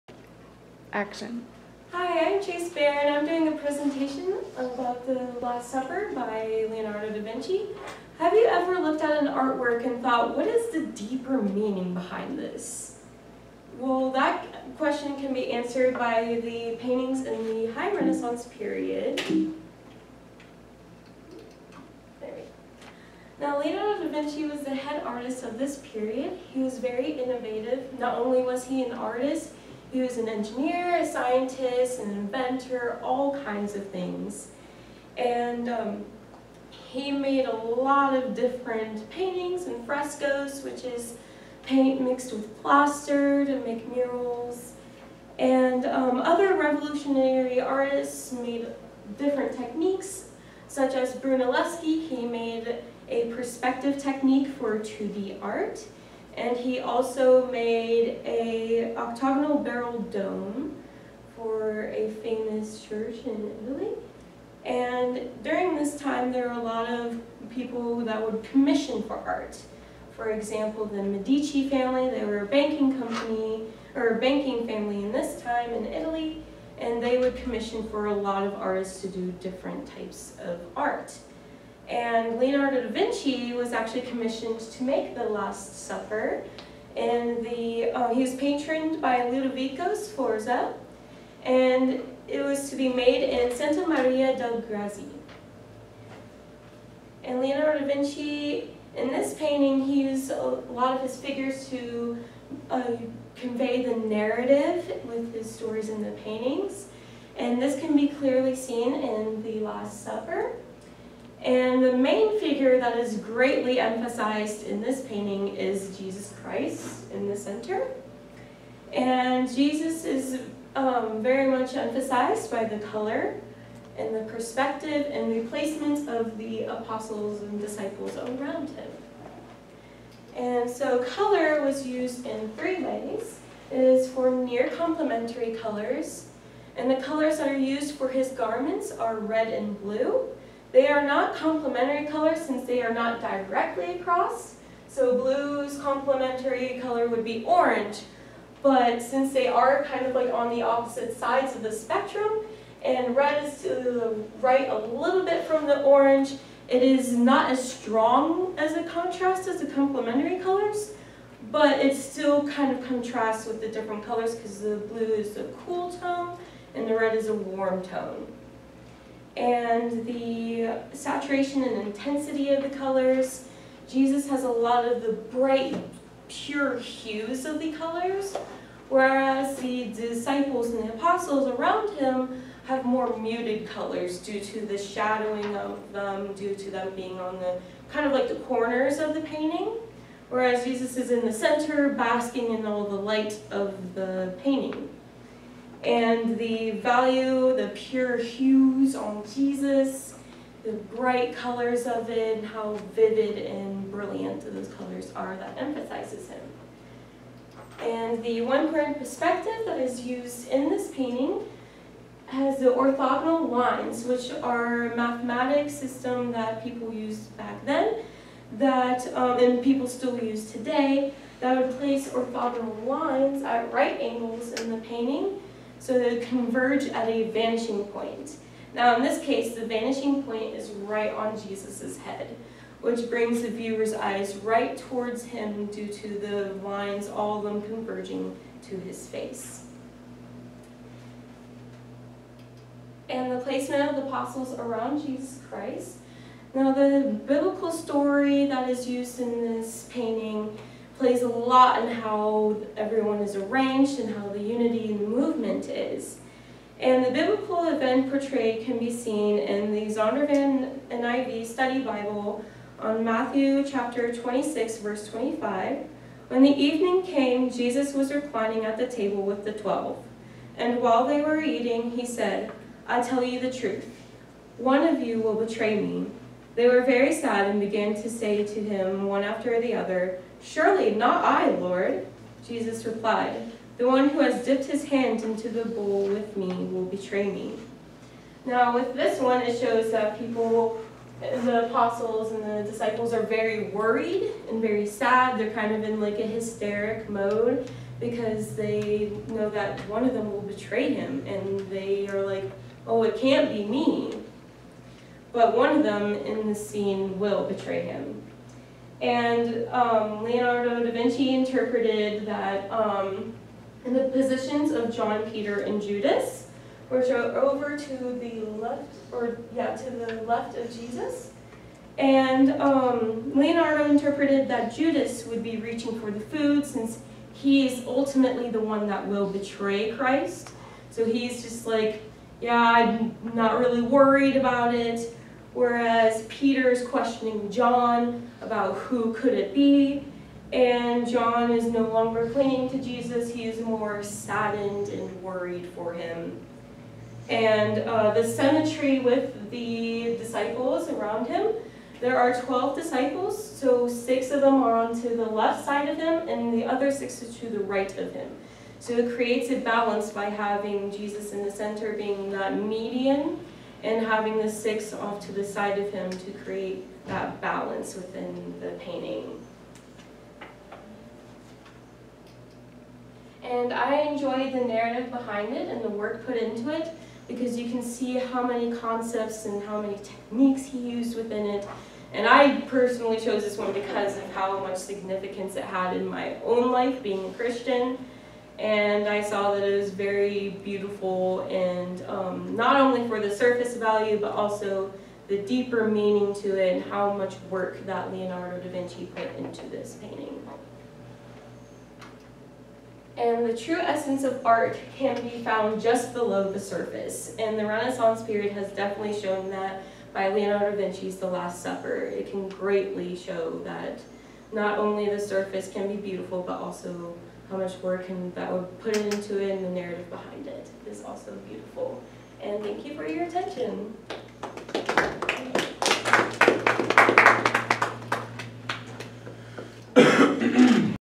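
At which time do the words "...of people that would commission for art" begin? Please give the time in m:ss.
1:06.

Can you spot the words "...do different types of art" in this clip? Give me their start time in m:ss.
1:19.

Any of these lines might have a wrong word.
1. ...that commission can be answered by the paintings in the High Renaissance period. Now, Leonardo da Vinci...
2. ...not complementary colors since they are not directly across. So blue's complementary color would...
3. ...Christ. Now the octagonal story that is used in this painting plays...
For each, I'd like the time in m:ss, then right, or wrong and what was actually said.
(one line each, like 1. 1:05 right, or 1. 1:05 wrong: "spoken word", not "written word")
1. 0:14 wrong: "question", not "commission"
2. 2:21 right
3. 4:05 wrong: "biblical", not "octagonal".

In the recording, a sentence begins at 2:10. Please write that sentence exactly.
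And so color was used in three ways.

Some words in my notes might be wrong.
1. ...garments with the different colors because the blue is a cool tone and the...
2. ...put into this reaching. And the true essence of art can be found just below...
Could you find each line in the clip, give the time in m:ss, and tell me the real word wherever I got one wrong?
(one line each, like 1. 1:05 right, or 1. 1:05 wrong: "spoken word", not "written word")
1. 2:42 wrong: "contrasts", not "garments"
2. 6:39 wrong: "painting", not "reaching".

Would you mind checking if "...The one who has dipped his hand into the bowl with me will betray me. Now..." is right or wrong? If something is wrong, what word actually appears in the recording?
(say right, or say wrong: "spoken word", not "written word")
right.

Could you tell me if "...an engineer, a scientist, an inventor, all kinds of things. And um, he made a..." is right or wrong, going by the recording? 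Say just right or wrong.
right.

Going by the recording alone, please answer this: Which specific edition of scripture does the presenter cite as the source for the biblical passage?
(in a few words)
Zondervan NIV Study Bible.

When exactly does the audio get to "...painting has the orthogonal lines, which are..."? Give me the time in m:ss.
3:30.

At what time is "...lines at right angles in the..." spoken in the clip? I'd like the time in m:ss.
3:42.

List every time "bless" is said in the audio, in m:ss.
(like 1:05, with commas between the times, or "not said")
not said.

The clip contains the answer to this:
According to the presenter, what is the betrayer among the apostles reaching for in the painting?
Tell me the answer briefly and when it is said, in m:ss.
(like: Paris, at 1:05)
The food, at 5:26.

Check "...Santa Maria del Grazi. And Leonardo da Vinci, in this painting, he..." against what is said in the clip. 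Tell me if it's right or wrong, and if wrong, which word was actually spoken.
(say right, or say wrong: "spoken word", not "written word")
right.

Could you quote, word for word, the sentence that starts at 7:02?
And thank you for your attention.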